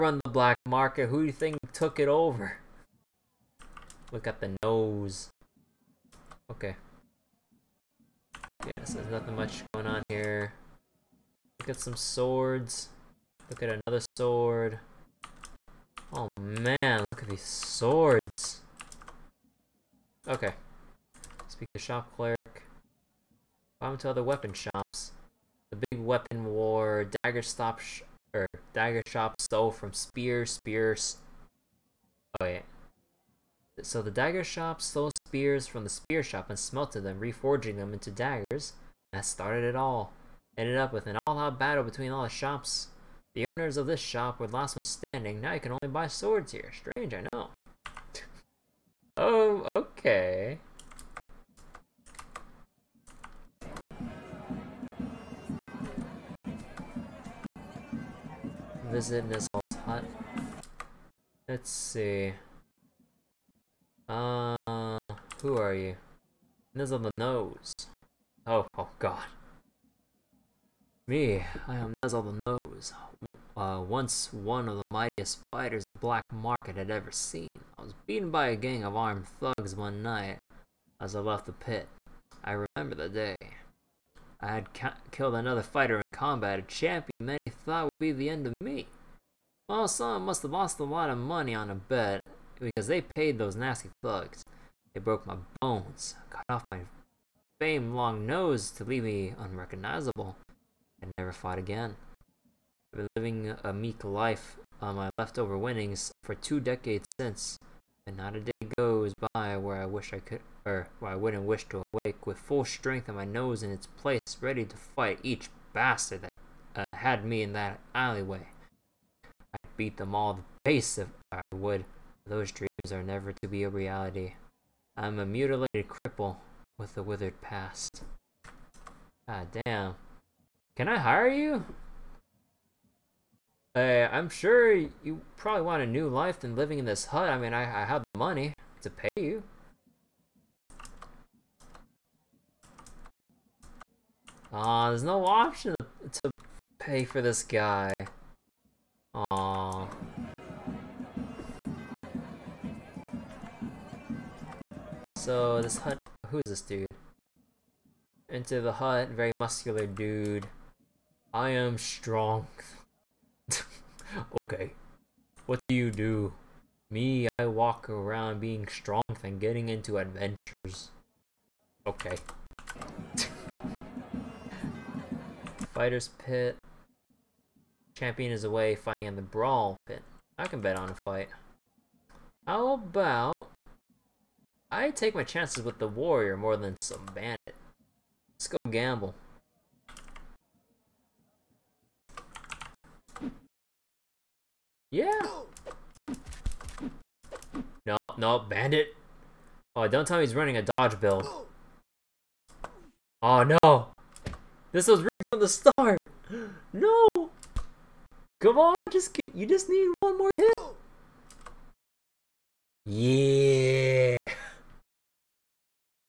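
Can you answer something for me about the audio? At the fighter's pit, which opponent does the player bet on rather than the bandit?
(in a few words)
The warrior.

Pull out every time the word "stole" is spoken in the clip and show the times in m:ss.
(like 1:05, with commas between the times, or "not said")
0:29, 0:34.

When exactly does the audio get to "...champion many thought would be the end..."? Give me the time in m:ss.
1:26.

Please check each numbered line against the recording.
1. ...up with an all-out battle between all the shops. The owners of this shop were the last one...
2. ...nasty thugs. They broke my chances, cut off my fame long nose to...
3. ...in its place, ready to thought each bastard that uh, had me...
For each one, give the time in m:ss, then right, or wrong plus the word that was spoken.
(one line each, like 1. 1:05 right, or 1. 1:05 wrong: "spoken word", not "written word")
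1. 0:40 right
2. 1:33 wrong: "bones", not "chances"
3. 1:53 wrong: "fight", not "thought".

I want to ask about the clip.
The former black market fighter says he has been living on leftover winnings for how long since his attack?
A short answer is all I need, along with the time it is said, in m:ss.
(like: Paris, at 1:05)
Two decades, at 1:46.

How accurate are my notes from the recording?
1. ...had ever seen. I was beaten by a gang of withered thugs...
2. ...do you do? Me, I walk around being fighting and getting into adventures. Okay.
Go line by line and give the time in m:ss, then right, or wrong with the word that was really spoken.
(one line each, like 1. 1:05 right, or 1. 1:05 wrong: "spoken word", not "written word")
1. 1:16 wrong: "armed", not "withered"
2. 2:45 wrong: "strong", not "fighting".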